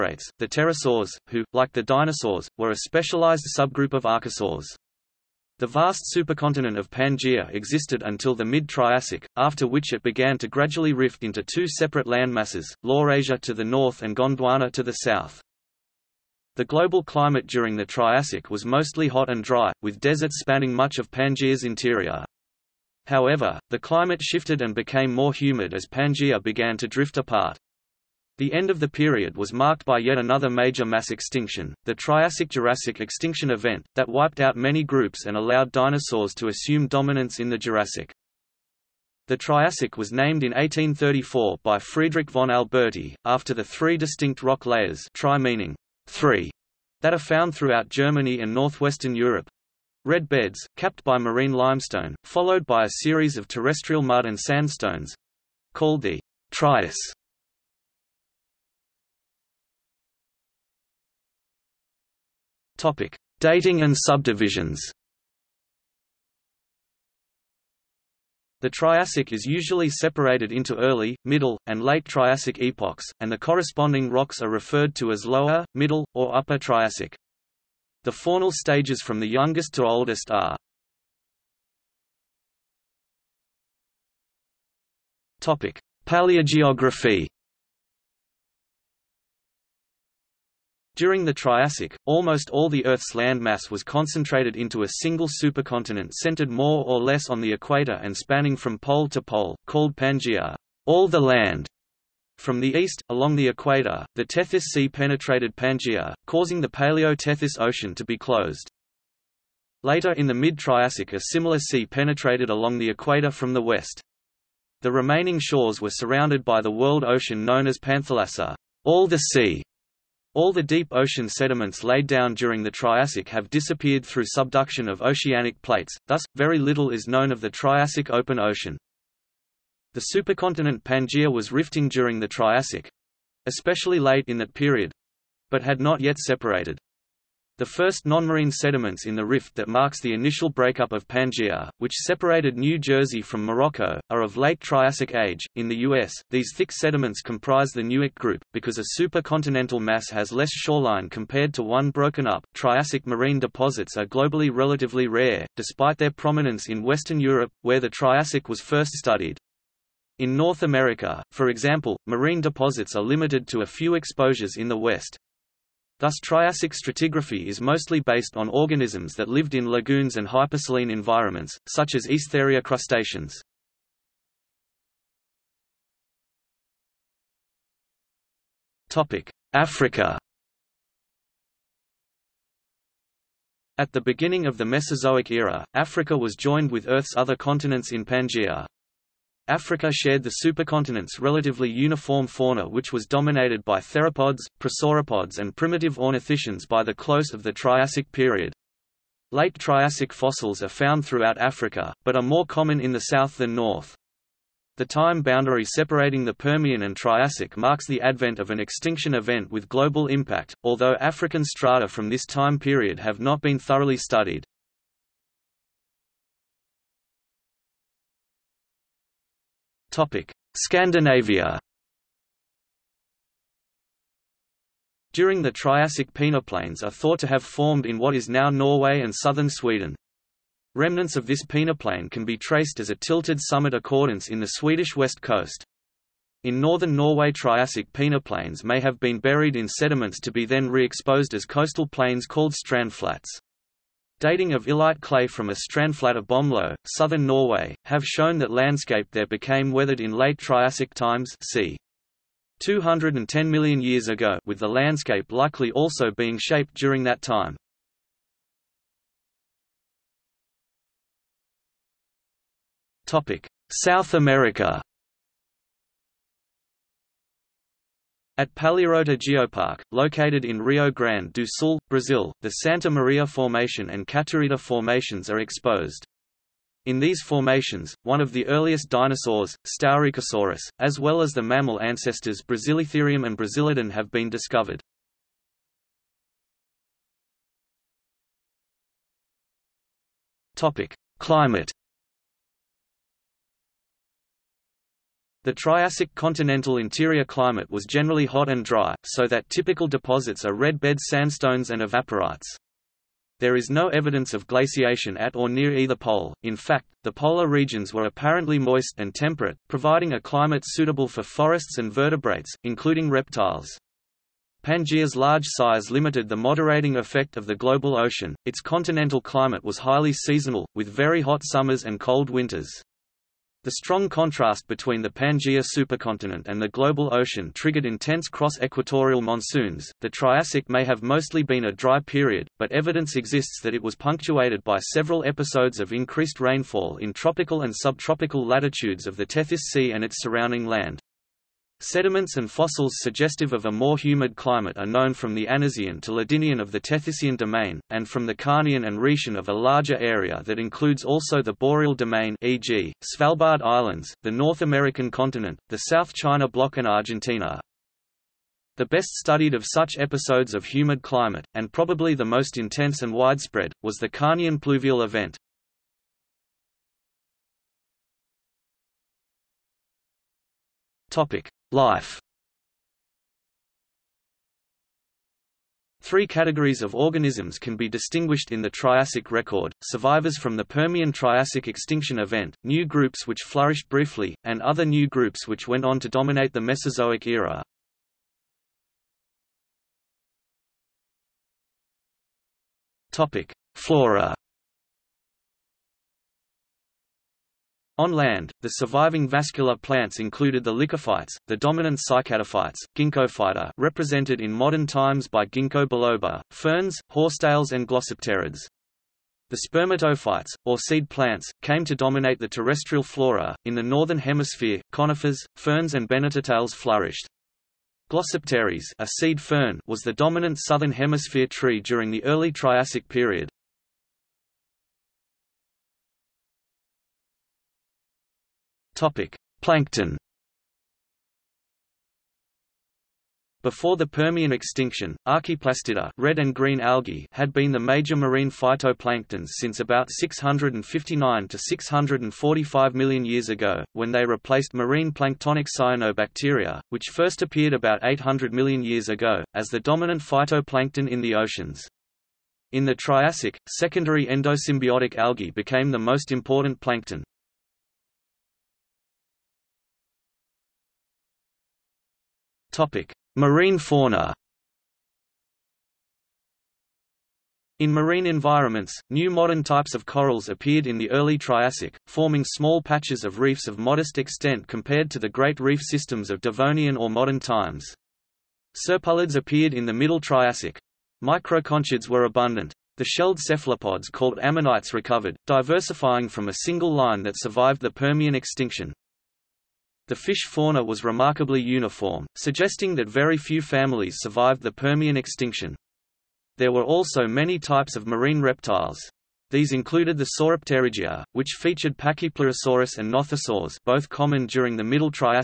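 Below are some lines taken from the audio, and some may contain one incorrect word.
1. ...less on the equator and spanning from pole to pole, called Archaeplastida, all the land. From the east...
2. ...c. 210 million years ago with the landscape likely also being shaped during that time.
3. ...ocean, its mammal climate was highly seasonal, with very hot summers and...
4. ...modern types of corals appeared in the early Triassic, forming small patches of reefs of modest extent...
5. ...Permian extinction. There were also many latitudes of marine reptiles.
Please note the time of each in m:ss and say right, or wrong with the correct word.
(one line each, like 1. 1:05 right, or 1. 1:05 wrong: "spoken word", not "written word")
1. 1:37 wrong: "Pangaea", not "Archaeplastida"
2. 4:11 right
3. 5:17 wrong: "continental", not "mammal"
4. 7:49 right
5. 8:14 wrong: "types", not "latitudes".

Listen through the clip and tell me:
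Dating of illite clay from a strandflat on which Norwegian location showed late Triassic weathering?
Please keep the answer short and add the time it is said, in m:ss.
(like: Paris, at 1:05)
Bømlo, at 4:06.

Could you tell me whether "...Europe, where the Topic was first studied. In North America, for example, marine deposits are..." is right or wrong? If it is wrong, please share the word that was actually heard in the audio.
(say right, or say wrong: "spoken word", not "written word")
wrong: "Triassic", not "Topic".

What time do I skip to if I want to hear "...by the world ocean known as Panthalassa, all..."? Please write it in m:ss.
1:56.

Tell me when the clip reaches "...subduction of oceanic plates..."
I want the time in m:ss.
2:04.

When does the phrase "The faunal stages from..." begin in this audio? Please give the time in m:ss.
1:18.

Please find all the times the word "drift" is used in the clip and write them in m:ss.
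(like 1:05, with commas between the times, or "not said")
0:26.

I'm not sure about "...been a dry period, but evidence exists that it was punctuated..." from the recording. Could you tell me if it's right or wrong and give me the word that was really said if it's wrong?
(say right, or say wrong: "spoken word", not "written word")
right.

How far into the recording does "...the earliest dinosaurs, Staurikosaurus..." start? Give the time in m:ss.
4:38.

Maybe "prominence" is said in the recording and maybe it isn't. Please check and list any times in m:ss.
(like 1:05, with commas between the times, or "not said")
2:36.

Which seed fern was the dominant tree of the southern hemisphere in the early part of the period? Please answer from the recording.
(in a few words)
Glossopteris.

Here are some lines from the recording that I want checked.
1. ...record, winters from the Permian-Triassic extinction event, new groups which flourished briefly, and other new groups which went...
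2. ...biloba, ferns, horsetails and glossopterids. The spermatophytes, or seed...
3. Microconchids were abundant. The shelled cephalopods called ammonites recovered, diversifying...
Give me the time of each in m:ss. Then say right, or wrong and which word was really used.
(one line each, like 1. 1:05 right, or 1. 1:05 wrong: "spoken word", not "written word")
1. 6:19 wrong: "survivors", not "winters"
2. 6:45 right
3. 8:01 right.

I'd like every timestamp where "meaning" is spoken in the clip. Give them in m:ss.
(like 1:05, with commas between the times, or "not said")
0:45.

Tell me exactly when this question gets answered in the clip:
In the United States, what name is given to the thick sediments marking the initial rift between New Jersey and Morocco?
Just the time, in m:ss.
2:27.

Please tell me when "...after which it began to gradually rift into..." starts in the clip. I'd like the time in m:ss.
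0:09.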